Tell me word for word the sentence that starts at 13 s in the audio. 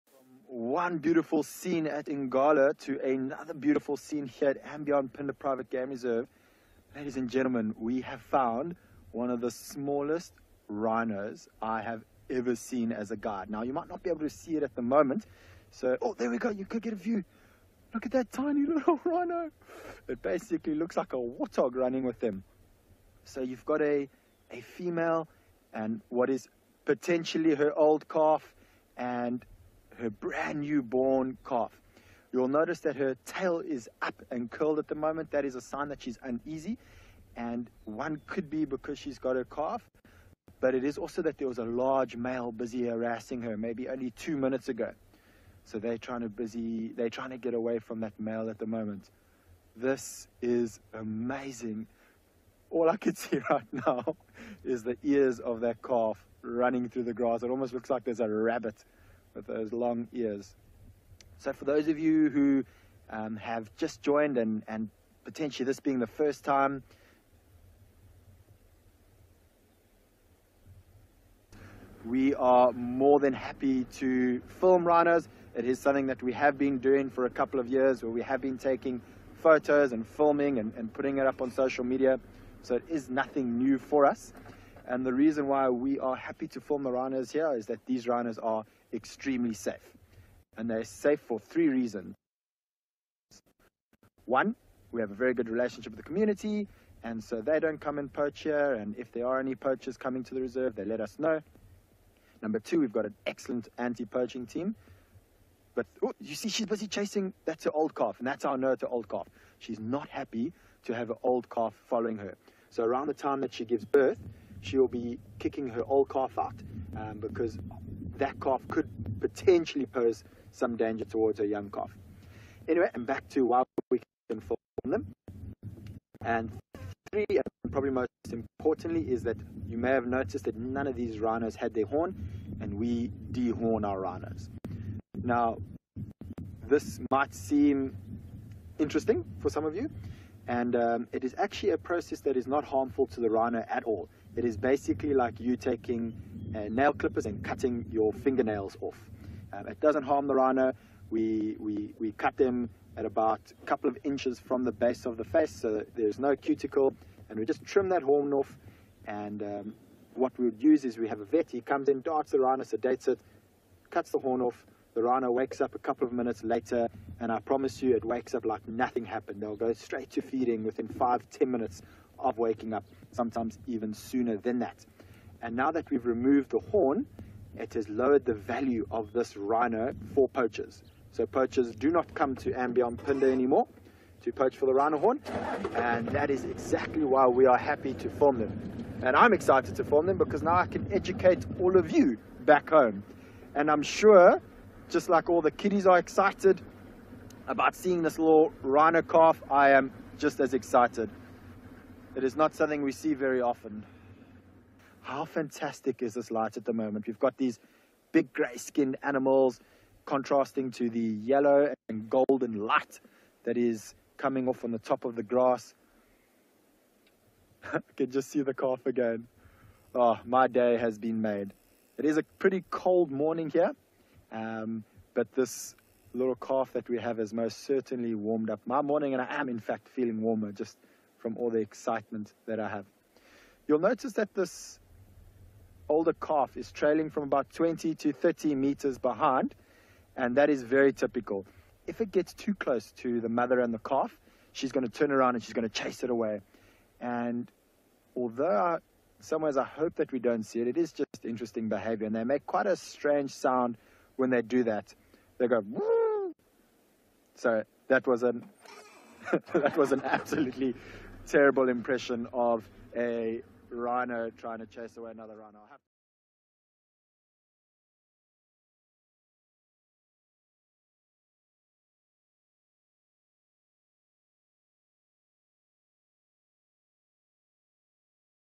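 Now, you might not be able to see it at the moment.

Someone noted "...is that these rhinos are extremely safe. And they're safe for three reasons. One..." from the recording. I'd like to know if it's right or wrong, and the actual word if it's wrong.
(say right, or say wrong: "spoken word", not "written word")
right.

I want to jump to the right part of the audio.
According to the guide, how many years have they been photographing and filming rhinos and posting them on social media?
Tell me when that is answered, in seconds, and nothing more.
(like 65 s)
77 s.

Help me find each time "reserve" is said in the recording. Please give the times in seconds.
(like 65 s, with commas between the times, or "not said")
5 s, 100 s.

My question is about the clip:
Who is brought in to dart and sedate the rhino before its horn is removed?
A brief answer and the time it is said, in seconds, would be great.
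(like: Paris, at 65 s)
a vet, at 161 s.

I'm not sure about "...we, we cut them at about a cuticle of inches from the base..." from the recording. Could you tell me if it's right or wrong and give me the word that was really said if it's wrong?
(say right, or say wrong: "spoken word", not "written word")
wrong: "couple", not "cuticle".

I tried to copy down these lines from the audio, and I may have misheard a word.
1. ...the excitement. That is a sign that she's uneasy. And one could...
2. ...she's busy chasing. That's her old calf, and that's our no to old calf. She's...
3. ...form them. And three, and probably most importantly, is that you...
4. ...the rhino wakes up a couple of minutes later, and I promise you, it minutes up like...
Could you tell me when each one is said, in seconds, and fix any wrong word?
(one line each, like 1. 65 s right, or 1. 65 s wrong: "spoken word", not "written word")
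1. 34 s wrong: "moment", not "excitement"
2. 106 s right
3. 124 s right
4. 164 s wrong: "wakes", not "minutes".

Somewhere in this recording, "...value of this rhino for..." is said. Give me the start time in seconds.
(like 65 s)
178 s.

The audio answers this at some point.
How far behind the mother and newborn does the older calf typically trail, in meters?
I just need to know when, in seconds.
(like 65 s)
237 s.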